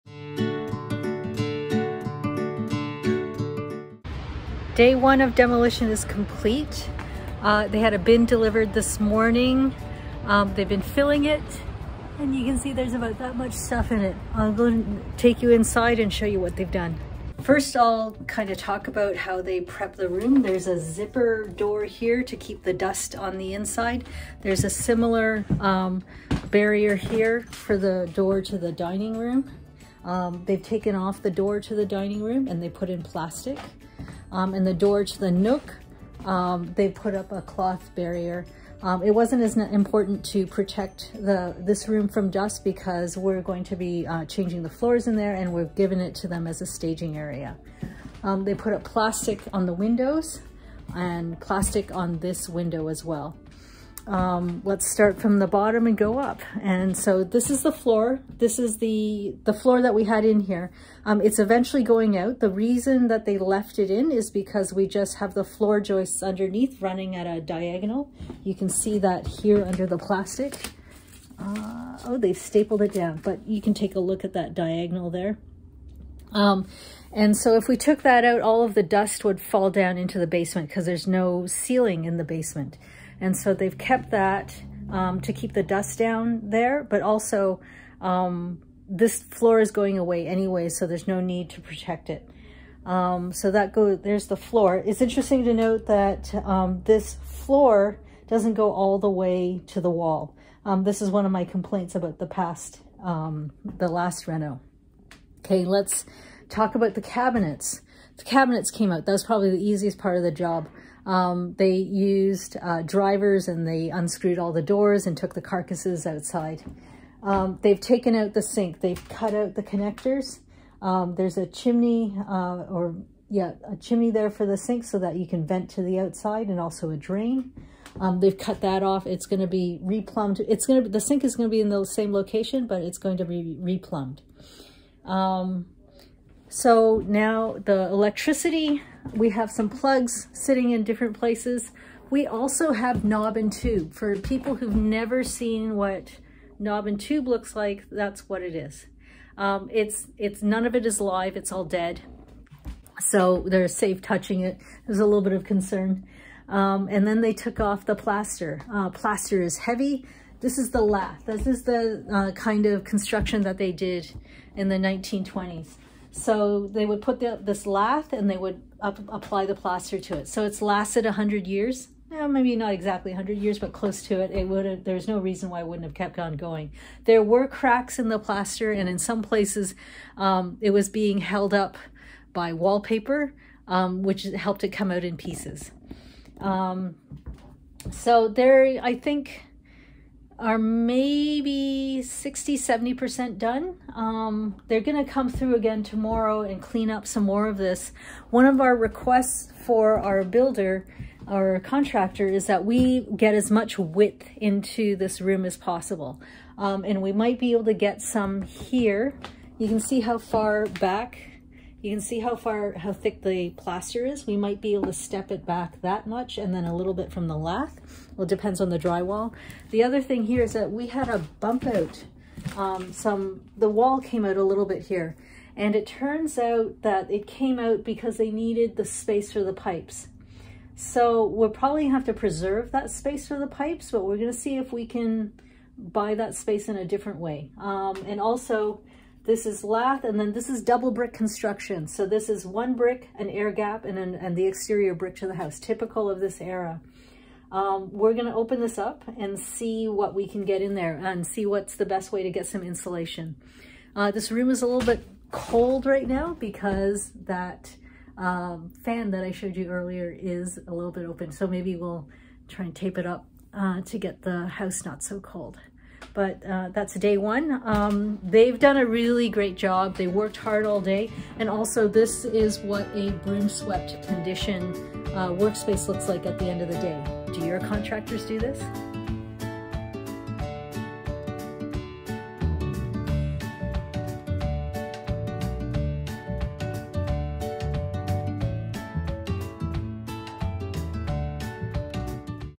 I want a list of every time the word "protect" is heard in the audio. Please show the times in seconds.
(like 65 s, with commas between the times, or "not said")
40 s, 91 s.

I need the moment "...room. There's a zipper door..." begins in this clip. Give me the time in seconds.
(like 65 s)
20 s.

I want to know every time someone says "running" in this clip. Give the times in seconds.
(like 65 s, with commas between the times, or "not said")
66 s.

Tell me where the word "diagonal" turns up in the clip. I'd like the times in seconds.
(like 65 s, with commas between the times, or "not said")
67 s, 74 s.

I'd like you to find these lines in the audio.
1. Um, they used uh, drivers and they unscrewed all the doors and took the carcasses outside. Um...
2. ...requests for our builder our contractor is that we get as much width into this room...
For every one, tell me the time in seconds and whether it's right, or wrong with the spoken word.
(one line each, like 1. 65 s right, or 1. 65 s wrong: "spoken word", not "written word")
1. 111 s right
2. 198 s right.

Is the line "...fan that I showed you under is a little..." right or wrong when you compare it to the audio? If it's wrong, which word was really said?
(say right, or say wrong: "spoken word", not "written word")
wrong: "earlier", not "under".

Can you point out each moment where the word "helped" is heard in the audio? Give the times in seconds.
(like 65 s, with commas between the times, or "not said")
184 s.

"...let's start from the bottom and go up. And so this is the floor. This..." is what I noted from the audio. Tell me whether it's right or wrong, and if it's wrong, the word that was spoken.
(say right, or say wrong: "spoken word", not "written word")
right.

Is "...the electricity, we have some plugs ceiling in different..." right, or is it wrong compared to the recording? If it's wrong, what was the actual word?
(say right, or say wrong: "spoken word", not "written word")
wrong: "sitting", not "ceiling".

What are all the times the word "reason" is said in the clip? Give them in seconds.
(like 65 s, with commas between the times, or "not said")
62 s, 175 s.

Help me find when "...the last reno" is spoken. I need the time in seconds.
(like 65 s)
103 s.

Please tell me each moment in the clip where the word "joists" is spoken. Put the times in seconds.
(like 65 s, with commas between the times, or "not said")
65 s.